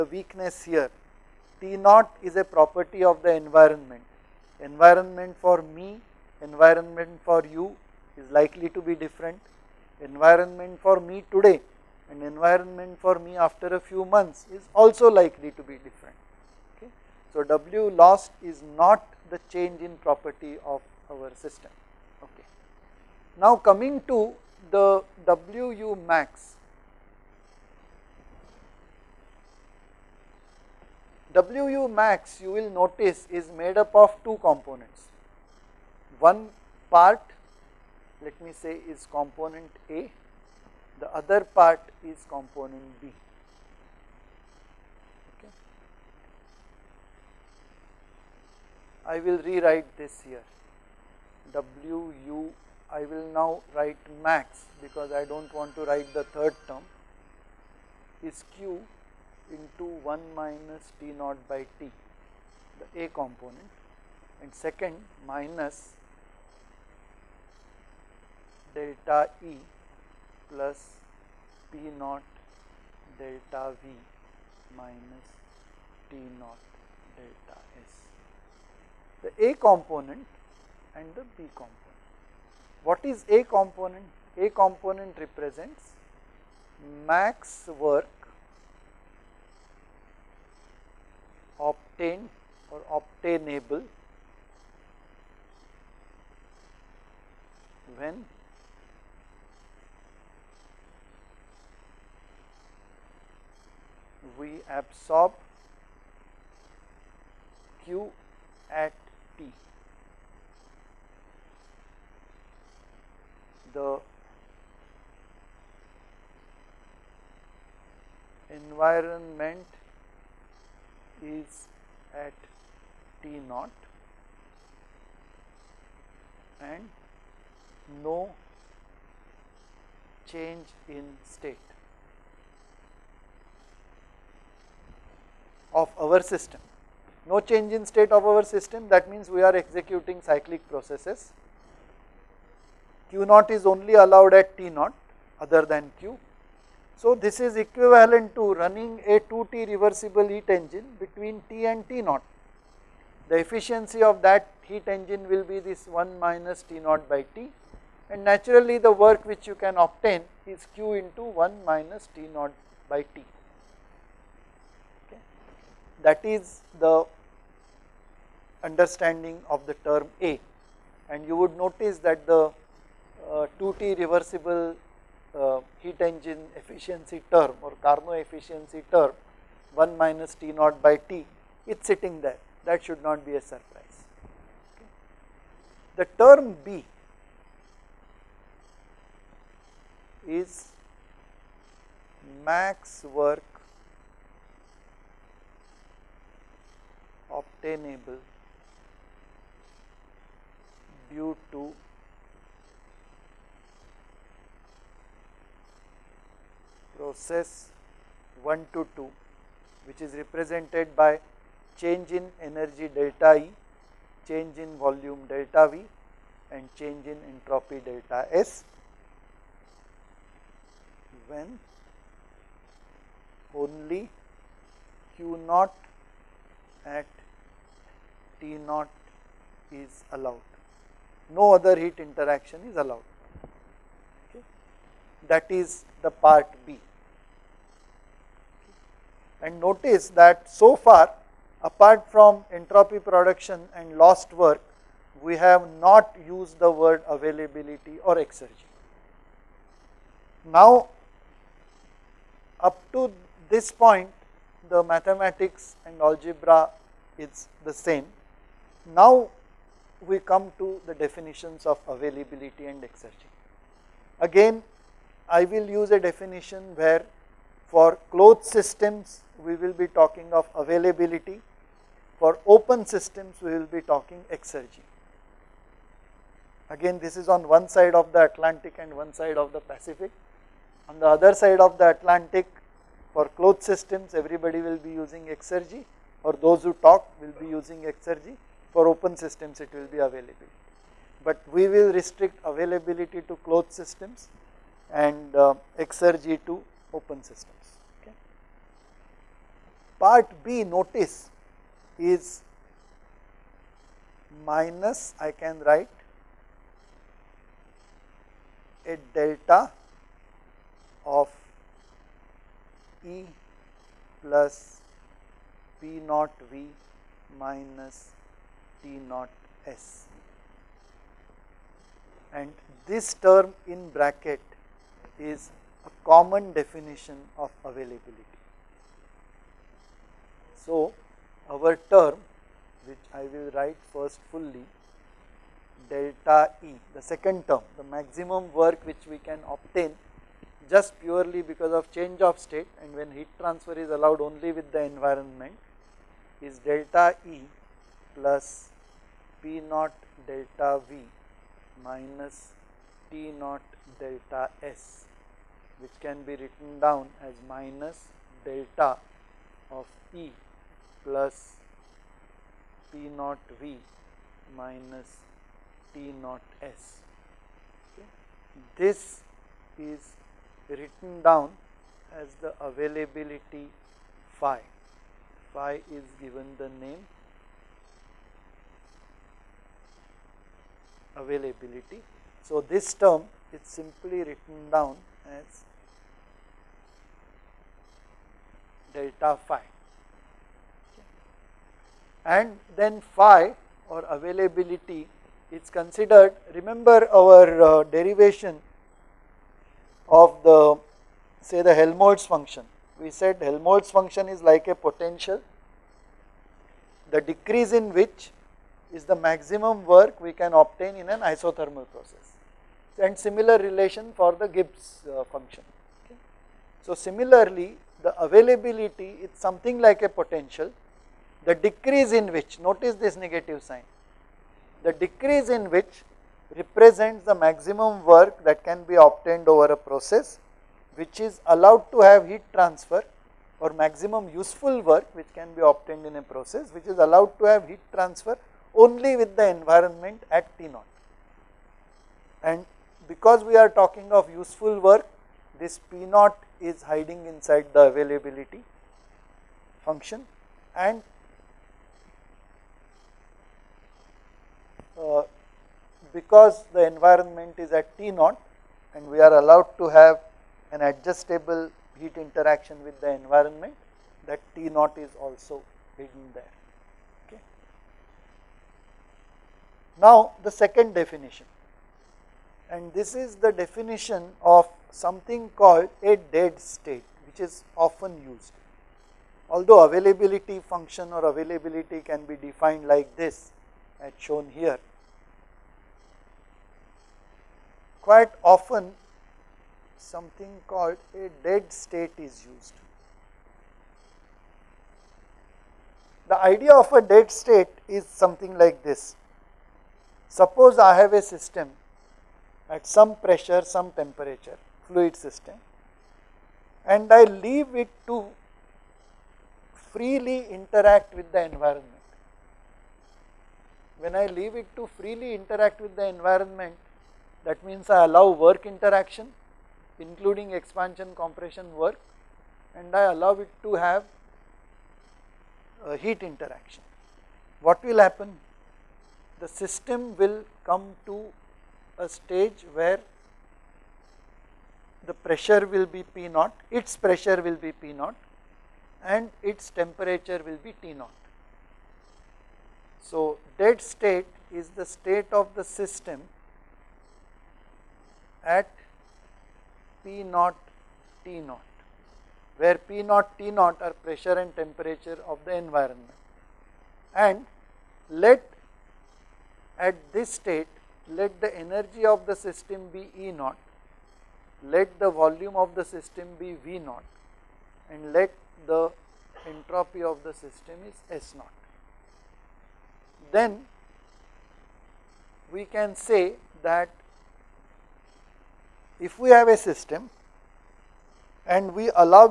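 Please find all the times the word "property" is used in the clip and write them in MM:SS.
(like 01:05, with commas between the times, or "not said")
00:02, 00:20.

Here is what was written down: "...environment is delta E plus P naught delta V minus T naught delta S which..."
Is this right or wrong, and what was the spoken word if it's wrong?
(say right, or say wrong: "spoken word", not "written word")
right.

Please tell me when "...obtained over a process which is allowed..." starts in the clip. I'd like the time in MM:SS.
07:09.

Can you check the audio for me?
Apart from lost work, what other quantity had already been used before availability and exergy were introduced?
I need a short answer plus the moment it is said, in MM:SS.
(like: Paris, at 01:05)
entropy production, at 04:02.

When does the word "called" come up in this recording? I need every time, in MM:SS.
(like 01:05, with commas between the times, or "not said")
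07:55, 08:10.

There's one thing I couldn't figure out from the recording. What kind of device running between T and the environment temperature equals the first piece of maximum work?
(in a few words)
2T reversible heat engine.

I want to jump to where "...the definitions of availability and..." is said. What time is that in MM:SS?
04:20.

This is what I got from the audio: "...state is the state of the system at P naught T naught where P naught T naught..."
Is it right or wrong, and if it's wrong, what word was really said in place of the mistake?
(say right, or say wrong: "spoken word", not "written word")
right.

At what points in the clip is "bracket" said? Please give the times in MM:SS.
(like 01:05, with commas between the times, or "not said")
05:23.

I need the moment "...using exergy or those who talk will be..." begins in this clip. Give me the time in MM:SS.
04:44.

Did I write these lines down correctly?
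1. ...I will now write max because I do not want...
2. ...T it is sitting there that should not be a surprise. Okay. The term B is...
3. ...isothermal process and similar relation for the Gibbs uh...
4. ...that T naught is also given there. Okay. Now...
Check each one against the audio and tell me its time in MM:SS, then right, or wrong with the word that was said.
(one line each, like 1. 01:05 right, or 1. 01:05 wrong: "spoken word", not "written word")
1. 00:52 right
2. 03:00 right
3. 06:51 right
4. 07:44 wrong: "hidden", not "given".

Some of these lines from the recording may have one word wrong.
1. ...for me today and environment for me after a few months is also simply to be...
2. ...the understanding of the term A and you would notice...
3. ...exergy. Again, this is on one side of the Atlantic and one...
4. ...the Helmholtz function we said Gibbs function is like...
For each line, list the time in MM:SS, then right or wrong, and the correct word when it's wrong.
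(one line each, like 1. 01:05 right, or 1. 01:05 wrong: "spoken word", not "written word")
1. 00:10 wrong: "likely", not "simply"
2. 02:46 right
3. 04:34 right
4. 06:41 wrong: "Helmholtz", not "Gibbs".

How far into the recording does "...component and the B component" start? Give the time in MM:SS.
01:19.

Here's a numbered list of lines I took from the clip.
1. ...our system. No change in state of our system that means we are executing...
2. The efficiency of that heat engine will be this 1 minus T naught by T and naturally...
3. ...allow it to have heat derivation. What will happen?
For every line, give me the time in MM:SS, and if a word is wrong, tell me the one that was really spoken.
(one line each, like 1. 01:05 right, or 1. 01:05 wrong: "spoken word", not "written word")
1. 02:15 right
2. 02:33 right
3. 08:43 wrong: "interaction", not "derivation".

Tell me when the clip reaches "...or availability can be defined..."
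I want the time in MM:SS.
08:01.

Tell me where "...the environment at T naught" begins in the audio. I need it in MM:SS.
07:19.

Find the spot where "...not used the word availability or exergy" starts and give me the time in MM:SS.
04:05.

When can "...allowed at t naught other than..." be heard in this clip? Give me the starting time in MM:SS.
02:24.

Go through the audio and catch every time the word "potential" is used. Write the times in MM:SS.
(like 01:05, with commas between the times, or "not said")
06:44, 07:00.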